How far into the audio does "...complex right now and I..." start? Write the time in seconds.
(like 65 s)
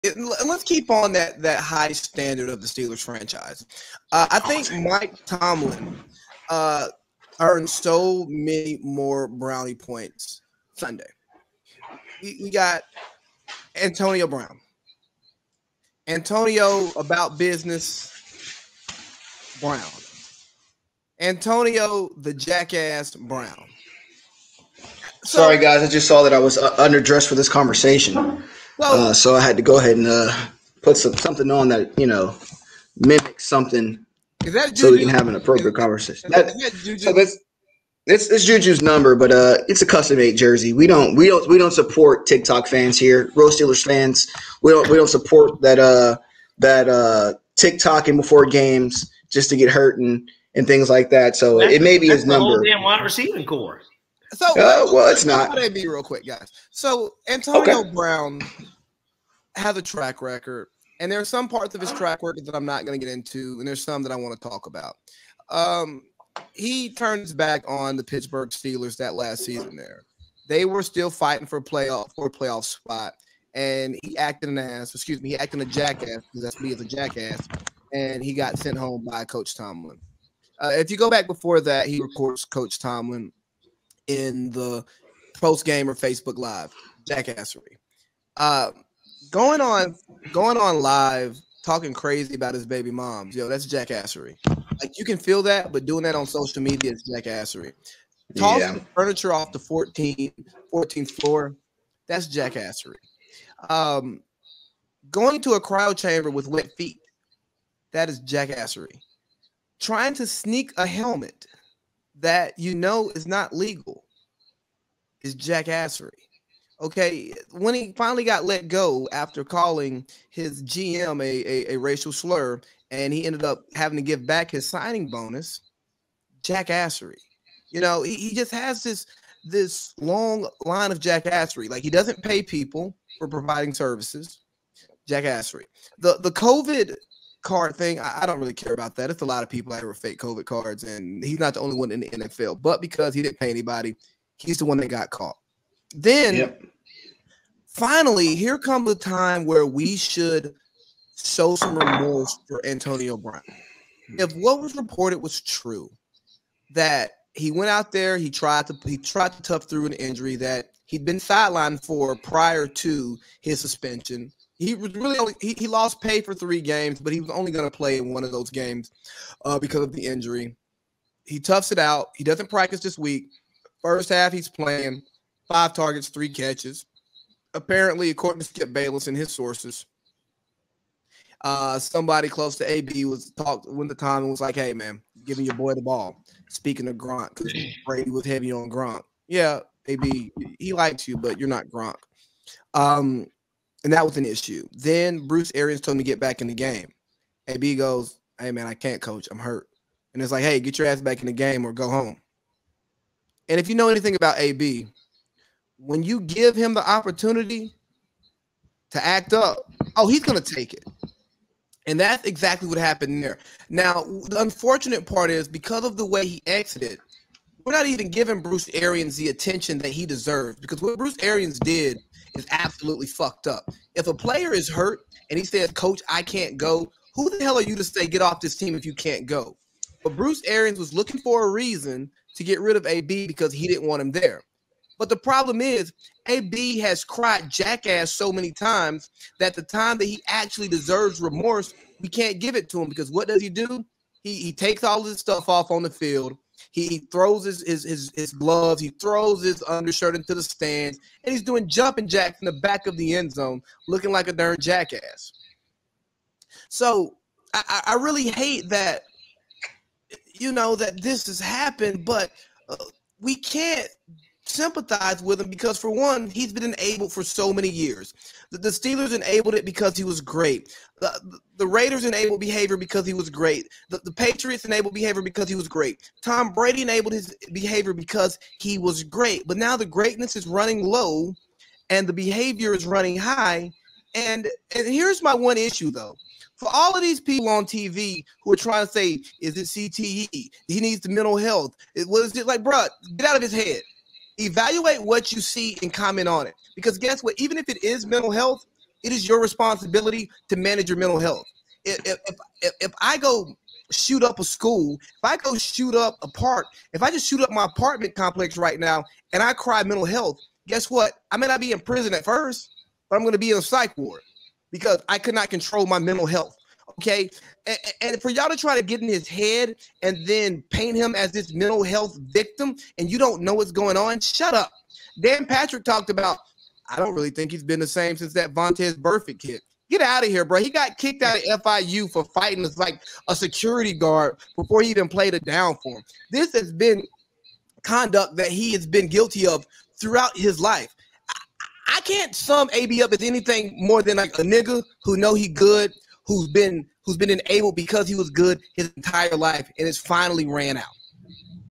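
308 s.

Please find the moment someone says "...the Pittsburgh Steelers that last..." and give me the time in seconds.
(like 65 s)
67 s.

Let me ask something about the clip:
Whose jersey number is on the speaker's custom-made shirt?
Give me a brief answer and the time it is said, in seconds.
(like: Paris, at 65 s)
Juju, at 38 s.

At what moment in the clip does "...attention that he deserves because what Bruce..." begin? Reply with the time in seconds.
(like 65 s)
219 s.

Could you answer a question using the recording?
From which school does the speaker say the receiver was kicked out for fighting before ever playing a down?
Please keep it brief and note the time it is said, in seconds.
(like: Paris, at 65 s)
FIU, at 331 s.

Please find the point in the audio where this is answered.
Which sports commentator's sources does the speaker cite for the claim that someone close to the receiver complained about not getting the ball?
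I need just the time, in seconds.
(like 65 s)
178 s.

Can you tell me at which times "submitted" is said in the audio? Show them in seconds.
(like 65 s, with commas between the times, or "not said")
not said.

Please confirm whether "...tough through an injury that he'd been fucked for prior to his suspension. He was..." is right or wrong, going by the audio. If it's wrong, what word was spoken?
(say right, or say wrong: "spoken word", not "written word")
wrong: "sidelined", not "fucked".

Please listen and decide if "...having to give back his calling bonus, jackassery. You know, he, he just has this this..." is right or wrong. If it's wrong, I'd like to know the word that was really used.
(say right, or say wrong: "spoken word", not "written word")
wrong: "signing", not "calling".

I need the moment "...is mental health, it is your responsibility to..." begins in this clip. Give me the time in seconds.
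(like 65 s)
297 s.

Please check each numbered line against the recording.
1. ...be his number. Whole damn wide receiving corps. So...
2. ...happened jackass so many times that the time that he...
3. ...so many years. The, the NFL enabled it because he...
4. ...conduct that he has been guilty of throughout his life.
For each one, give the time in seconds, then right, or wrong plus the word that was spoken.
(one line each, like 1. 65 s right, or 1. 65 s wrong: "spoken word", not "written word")
1. 51 s right
2. 237 s wrong: "cried", not "happened"
3. 267 s wrong: "Steelers", not "NFL"
4. 337 s right.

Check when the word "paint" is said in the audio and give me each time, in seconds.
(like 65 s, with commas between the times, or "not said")
320 s.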